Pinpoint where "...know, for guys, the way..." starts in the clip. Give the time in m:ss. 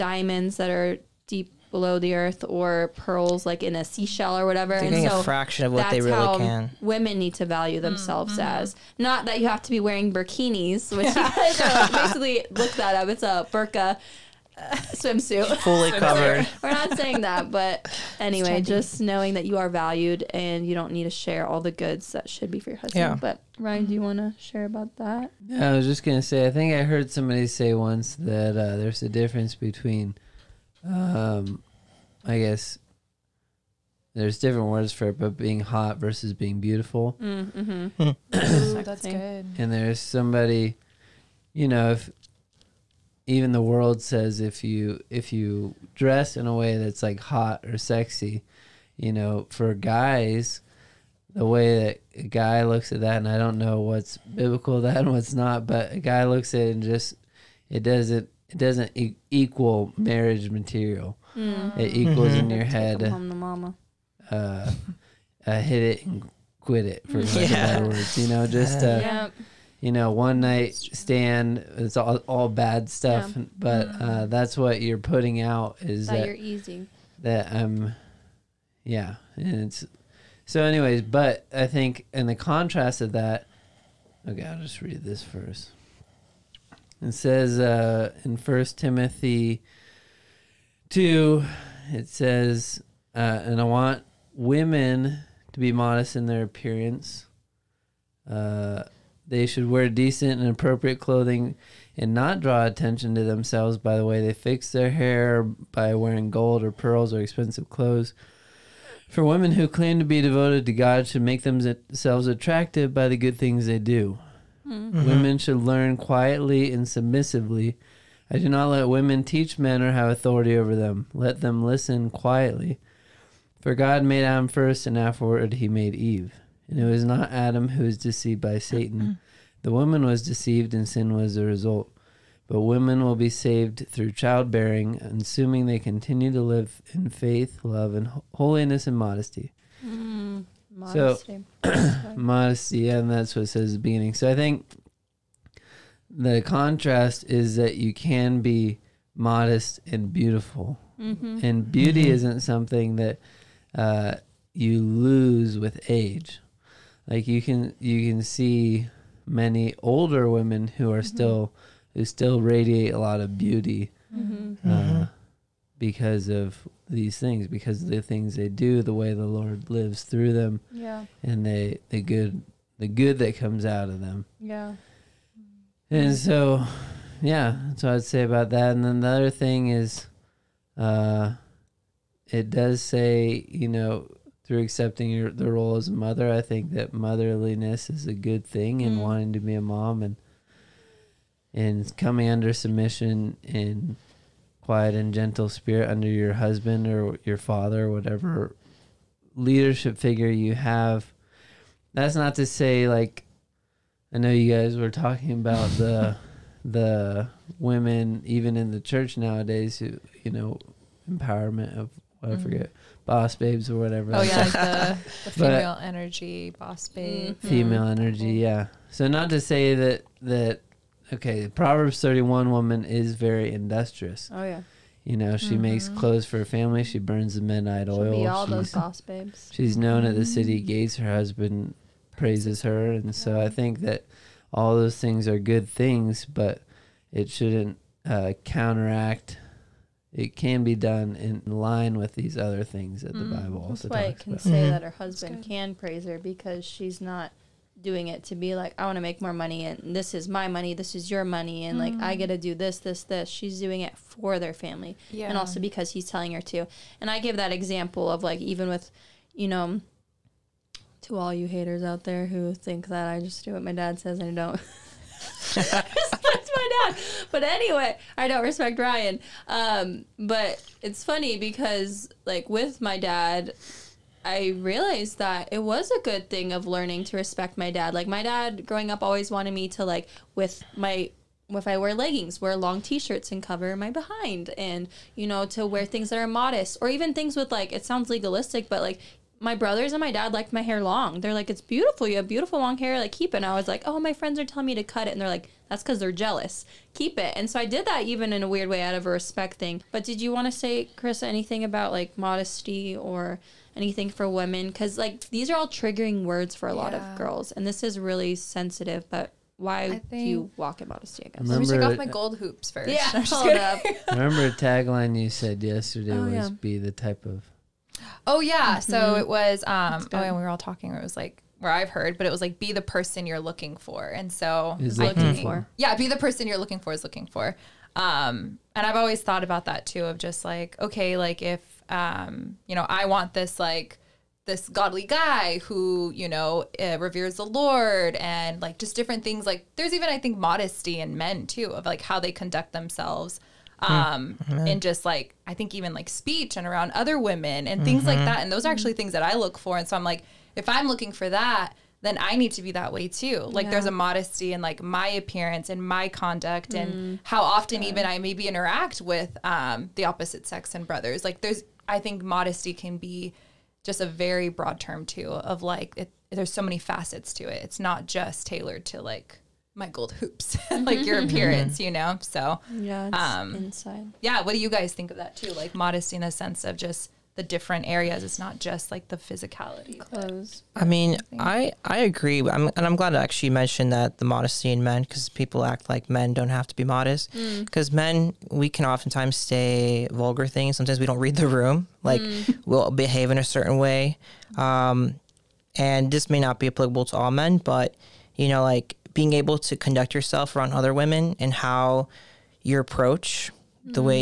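0:49.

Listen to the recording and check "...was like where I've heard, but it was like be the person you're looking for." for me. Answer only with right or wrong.
right.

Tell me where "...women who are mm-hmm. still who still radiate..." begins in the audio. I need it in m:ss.
2:40.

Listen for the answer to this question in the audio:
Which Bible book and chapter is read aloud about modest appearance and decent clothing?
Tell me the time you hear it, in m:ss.
1:28.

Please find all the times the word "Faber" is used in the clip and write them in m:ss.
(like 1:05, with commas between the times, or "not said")
not said.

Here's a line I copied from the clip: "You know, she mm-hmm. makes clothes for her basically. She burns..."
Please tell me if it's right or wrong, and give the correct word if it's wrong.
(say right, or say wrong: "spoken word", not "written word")
wrong: "family", not "basically".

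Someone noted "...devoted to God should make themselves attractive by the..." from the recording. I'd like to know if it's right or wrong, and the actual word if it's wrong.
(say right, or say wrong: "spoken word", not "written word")
right.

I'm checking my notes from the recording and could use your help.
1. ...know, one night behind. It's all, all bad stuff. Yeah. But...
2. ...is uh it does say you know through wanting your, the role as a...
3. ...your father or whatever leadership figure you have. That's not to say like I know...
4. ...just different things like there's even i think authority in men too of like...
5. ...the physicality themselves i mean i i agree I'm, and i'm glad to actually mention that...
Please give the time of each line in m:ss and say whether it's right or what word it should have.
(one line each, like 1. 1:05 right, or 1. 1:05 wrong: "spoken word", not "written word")
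1. 1:09 wrong: "stand", not "behind"
2. 2:59 wrong: "accepting", not "wanting"
3. 3:17 right
4. 5:38 wrong: "modesty", not "authority"
5. 6:19 wrong: "clothes", not "themselves".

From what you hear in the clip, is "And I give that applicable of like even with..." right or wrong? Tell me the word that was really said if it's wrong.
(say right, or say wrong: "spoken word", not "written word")
wrong: "example", not "applicable".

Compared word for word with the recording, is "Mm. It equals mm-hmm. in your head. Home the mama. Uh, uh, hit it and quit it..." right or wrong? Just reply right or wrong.
right.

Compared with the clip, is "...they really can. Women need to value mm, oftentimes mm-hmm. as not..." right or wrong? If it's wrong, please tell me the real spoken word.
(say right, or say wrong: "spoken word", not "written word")
wrong: "themselves", not "oftentimes".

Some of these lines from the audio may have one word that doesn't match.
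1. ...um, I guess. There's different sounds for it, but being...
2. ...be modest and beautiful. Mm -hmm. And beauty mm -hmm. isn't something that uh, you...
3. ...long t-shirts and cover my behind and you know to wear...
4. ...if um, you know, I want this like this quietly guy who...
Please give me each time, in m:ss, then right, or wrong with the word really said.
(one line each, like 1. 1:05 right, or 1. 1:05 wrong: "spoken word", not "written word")
1. 0:30 wrong: "words", not "sounds"
2. 2:28 right
3. 4:42 right
4. 5:31 wrong: "godly", not "quietly".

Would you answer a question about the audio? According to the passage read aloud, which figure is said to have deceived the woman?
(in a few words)
Satan.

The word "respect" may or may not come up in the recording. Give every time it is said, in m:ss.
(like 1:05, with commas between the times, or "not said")
4:28, 4:37, 4:59.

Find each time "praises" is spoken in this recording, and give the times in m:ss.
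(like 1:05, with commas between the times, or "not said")
3:52, 4:05.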